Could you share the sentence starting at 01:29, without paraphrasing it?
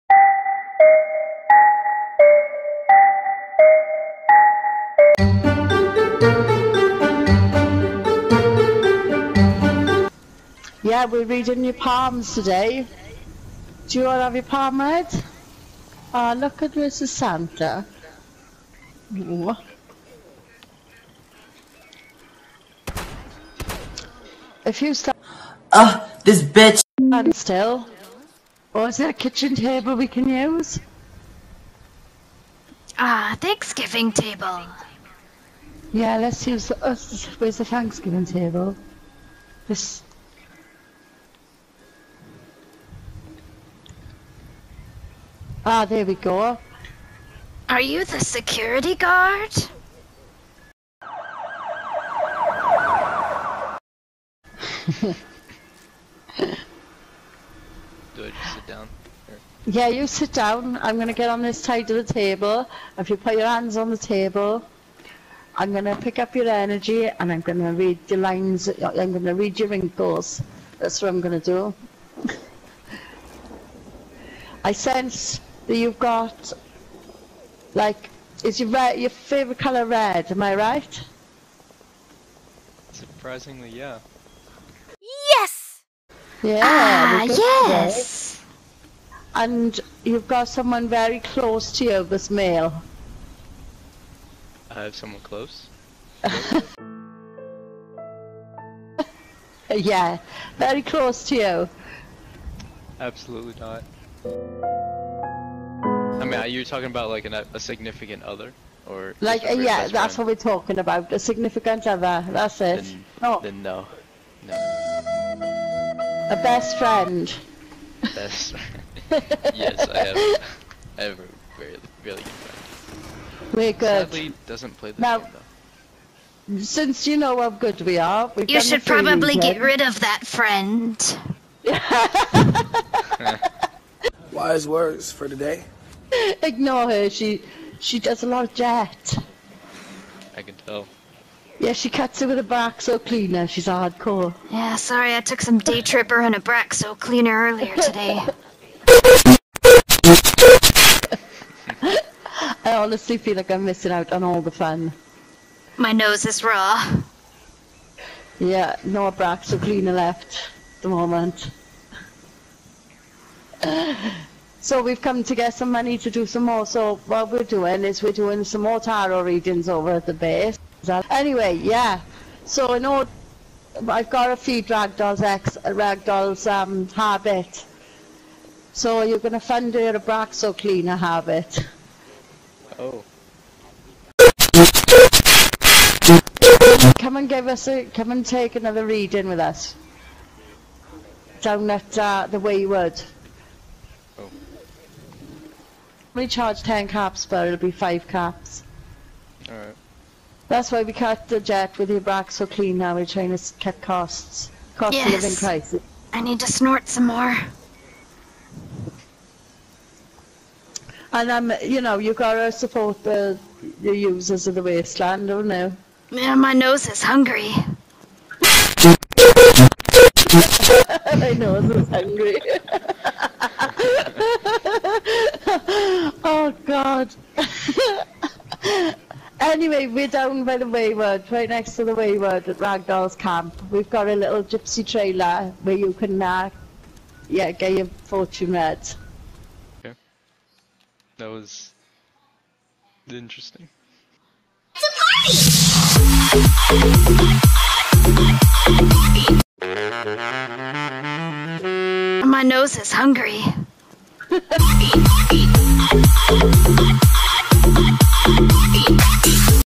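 And you've got someone very close to you this male.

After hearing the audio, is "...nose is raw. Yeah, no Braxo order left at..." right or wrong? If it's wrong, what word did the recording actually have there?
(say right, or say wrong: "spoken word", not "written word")
wrong: "cleaner", not "order".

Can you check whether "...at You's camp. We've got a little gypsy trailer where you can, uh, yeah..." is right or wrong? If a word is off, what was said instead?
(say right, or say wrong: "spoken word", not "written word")
wrong: "Ragdoll", not "You".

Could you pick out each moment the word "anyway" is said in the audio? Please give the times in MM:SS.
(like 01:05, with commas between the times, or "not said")
02:51, 03:49.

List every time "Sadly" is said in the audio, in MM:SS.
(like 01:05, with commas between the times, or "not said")
02:04.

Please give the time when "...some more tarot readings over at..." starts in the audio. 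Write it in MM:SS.
02:48.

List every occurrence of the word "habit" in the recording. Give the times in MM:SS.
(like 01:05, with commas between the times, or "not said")
02:56, 03:00.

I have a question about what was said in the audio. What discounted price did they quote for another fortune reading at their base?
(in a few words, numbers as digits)
5 caps.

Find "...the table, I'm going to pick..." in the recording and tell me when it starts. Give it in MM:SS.
01:03.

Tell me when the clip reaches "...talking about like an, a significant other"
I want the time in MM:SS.
01:46.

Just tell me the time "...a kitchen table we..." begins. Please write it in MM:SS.
00:29.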